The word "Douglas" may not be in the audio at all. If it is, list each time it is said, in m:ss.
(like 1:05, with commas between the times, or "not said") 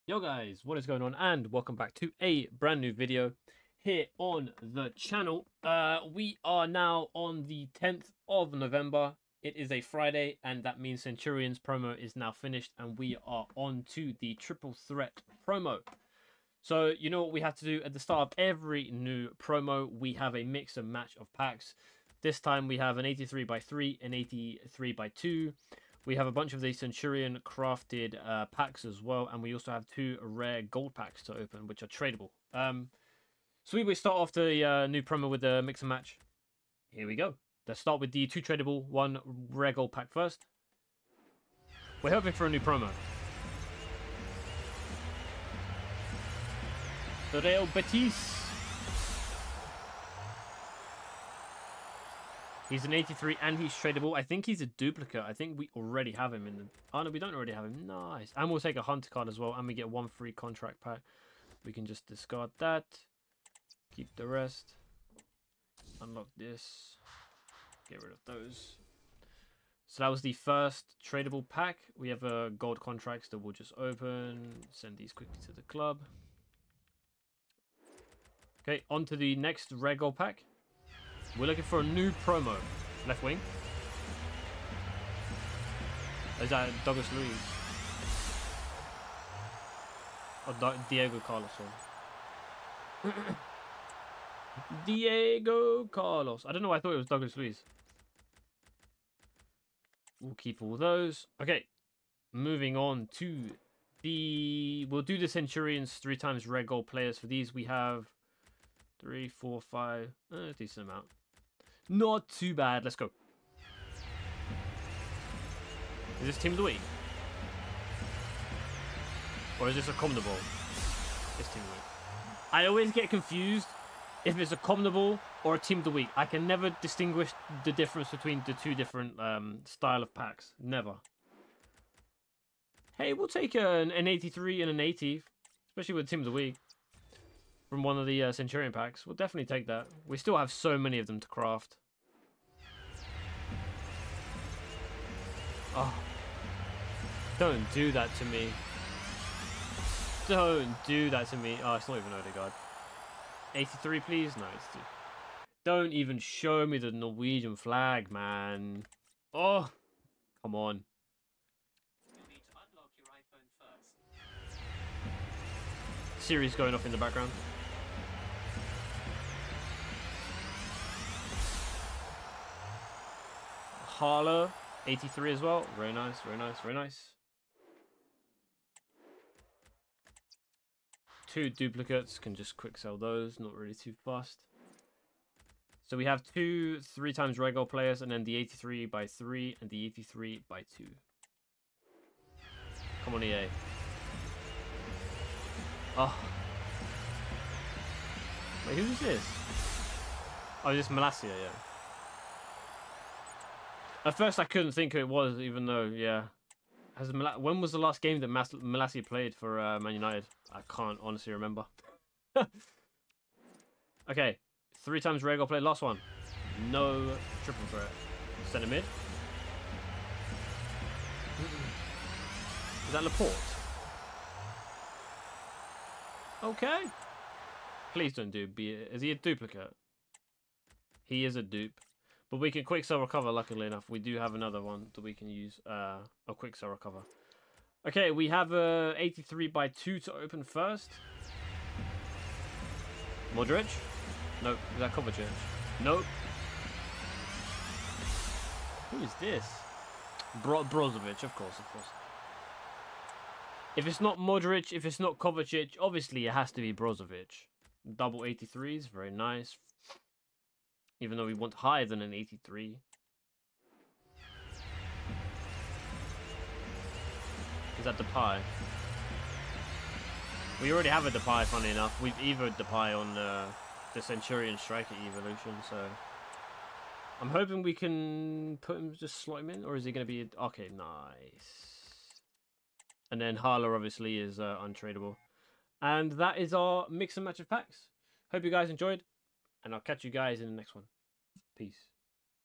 1:26, 1:37.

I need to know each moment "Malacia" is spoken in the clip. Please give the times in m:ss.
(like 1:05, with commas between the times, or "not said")
3:20, 3:28.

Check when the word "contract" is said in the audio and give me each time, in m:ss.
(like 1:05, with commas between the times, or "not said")
1:00, 1:12.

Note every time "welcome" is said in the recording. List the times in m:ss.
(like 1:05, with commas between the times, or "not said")
0:01.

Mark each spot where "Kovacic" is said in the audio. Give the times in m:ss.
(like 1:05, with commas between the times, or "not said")
4:04, 4:15.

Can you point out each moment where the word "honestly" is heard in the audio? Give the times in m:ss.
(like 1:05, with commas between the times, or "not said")
3:31.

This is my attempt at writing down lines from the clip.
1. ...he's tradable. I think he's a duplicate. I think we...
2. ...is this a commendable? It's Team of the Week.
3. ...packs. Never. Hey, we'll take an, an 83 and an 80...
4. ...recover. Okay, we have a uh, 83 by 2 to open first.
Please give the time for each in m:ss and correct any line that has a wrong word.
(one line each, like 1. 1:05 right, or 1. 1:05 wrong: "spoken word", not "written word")
1. 0:53 right
2. 1:59 right
3. 2:10 right
4. 3:56 right.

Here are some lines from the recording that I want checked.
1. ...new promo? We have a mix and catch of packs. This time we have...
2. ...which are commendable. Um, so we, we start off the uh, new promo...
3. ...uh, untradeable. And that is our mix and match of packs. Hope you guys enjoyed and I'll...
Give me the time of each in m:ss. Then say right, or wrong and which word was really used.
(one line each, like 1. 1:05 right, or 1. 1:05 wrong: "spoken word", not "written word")
1. 0:18 wrong: "match", not "catch"
2. 0:31 wrong: "tradable", not "commendable"
3. 4:44 right.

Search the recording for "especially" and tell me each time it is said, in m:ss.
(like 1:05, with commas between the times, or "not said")
2:15.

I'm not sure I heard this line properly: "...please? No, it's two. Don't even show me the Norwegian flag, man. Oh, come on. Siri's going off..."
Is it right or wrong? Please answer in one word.
right.